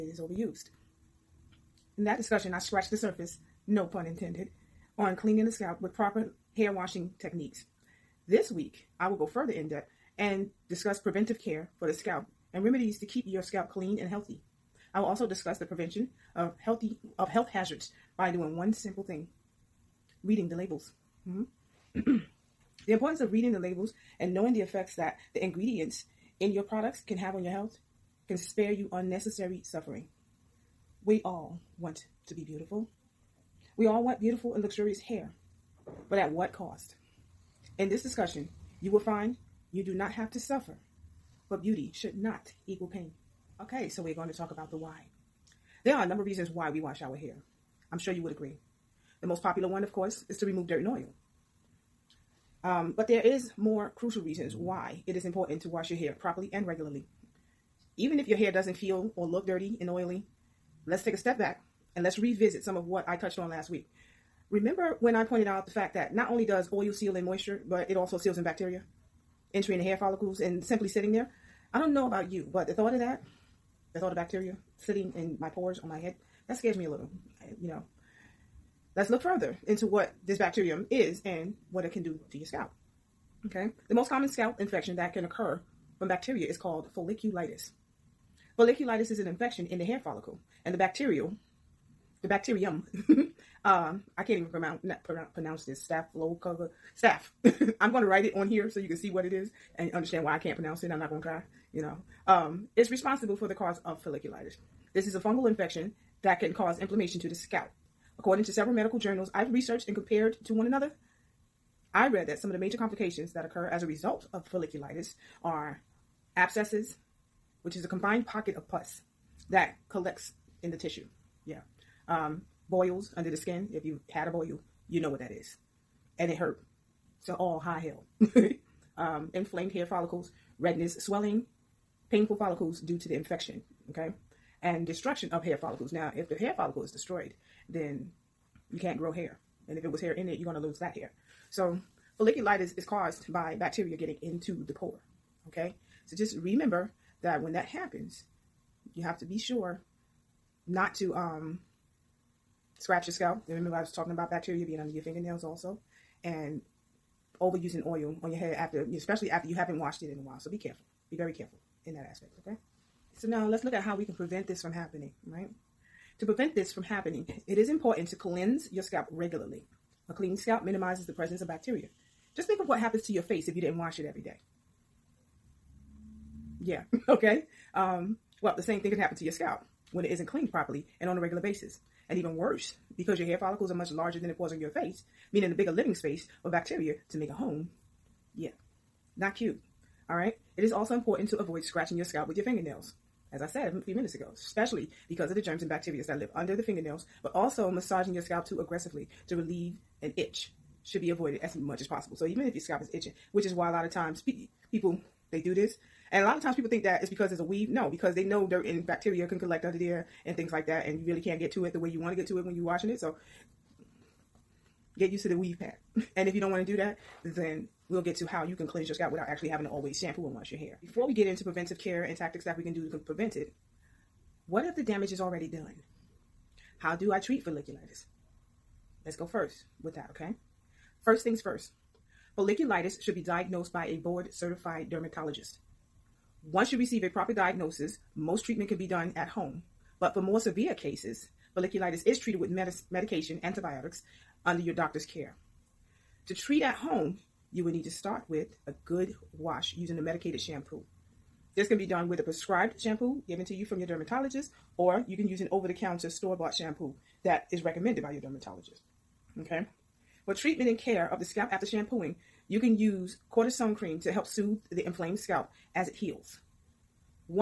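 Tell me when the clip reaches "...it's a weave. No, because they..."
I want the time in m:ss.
3:27.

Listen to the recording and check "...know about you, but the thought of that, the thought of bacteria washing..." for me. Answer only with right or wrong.
wrong.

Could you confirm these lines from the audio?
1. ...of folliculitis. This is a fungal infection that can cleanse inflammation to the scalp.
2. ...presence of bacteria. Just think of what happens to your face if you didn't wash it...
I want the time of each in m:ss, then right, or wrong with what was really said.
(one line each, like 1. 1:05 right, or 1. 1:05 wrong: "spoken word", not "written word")
1. 1:43 wrong: "cause", not "cleanse"
2. 2:51 right.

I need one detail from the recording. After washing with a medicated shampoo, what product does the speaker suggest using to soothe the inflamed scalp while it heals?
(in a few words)
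cortisone cream.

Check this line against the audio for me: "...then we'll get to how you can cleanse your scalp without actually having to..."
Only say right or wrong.
right.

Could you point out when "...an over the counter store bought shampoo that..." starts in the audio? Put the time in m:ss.
4:15.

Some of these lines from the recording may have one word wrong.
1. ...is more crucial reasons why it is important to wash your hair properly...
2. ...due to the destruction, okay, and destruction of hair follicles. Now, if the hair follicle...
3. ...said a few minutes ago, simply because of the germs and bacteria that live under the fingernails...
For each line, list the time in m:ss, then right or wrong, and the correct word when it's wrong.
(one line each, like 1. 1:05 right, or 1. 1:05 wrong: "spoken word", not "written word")
1. 0:53 right
2. 2:12 wrong: "infection", not "destruction"
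3. 3:13 wrong: "especially", not "simply".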